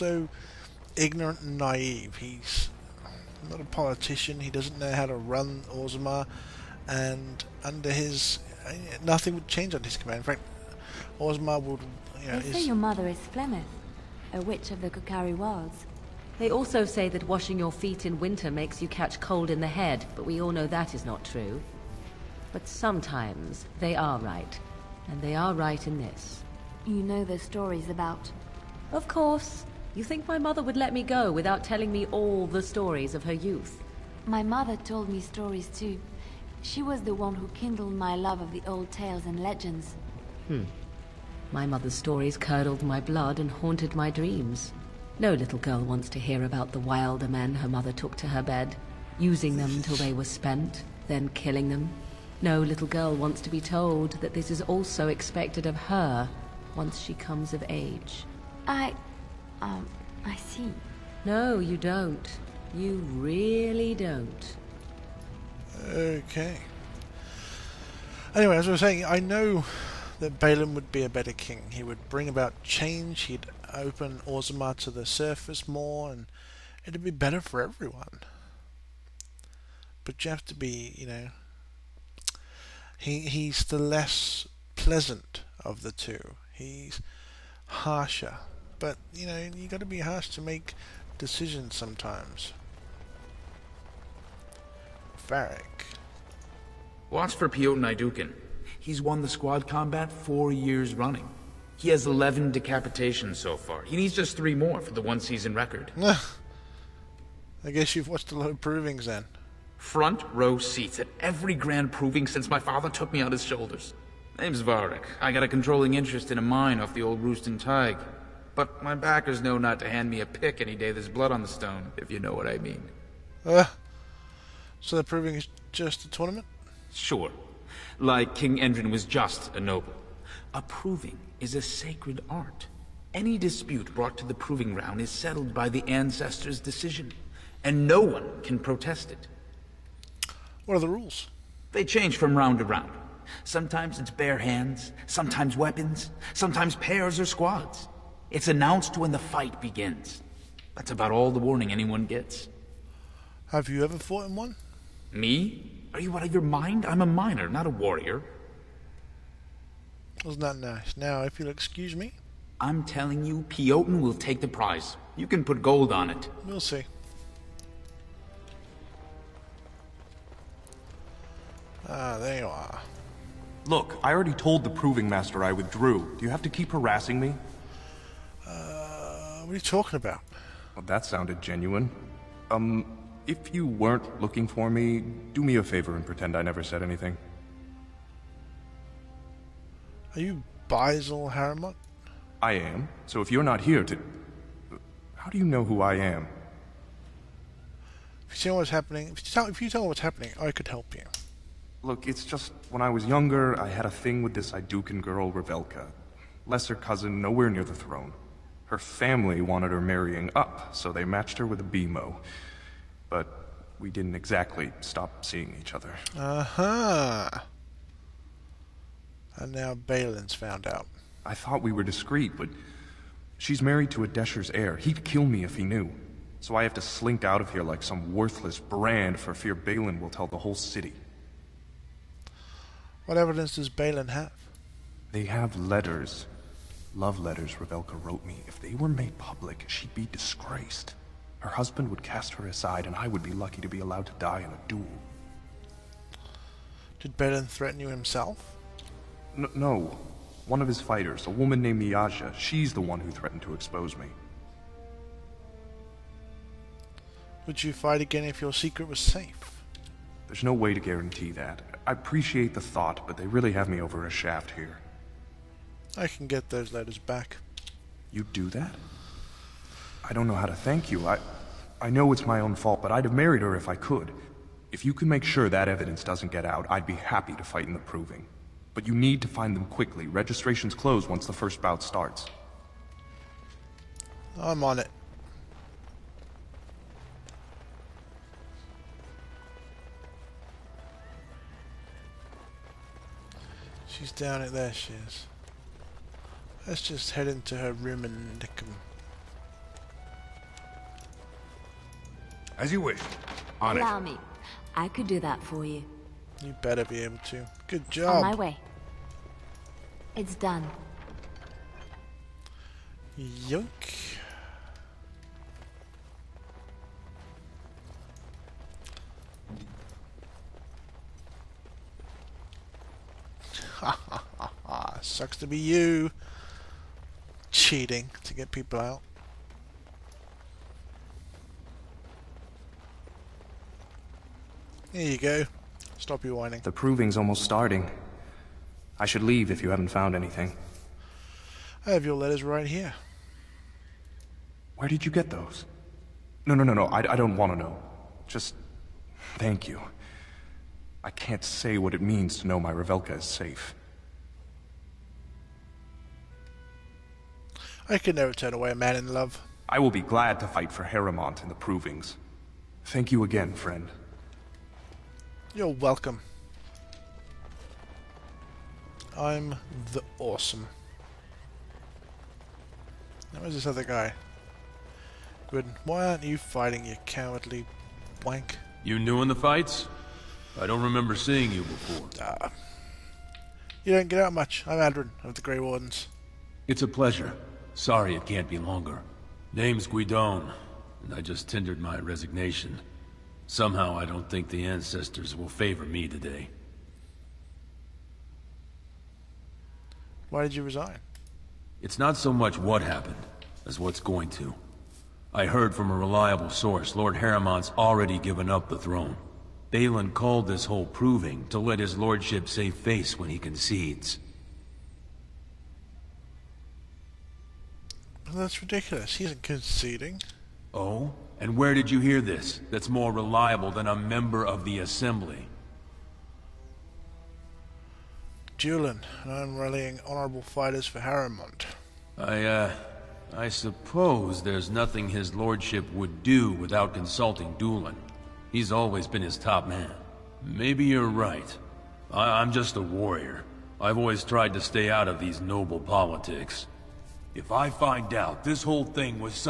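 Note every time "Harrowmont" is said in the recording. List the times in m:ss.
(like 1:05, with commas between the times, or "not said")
6:00, 6:47, 7:10.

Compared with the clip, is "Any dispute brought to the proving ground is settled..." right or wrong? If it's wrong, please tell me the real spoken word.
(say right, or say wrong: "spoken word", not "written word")
right.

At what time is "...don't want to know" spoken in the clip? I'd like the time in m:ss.
5:47.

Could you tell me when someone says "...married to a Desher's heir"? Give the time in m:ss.
3:43.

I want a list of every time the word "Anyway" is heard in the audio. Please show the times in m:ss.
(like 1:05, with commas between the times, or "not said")
1:08.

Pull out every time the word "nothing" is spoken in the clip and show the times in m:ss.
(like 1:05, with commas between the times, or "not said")
0:09, 7:14.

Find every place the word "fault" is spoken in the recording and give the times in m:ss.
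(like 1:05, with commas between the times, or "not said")
4:32.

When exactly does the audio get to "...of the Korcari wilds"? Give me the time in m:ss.
0:14.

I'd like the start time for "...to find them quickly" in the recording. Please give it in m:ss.
4:39.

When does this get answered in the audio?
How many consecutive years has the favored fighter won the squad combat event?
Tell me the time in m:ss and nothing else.
1:40.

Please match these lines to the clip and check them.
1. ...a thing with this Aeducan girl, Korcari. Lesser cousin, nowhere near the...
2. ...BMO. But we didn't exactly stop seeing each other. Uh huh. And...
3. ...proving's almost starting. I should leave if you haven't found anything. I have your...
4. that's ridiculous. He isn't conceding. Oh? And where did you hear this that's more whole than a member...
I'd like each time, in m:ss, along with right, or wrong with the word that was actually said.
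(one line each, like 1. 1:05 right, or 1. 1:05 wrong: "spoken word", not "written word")
1. 3:23 wrong: "Revelka", not "Korcari"
2. 3:31 right
3. 5:36 right
4. 6:58 wrong: "reliable", not "whole".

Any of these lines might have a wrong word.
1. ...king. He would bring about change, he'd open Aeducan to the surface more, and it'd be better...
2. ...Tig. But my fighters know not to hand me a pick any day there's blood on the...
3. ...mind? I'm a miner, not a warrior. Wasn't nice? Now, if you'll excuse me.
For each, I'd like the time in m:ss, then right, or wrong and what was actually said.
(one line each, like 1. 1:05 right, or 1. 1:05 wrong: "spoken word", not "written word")
1. 1:11 wrong: "Orzammar", not "Aeducan"
2. 1:57 wrong: "backers", not "fighters"
3. 2:36 right.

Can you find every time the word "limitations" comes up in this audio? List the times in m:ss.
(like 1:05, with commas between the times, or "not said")
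not said.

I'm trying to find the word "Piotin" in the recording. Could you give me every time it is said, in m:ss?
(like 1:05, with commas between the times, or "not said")
1:37, 2:43.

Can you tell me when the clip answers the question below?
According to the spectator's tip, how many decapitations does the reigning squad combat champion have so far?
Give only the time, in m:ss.
1:42.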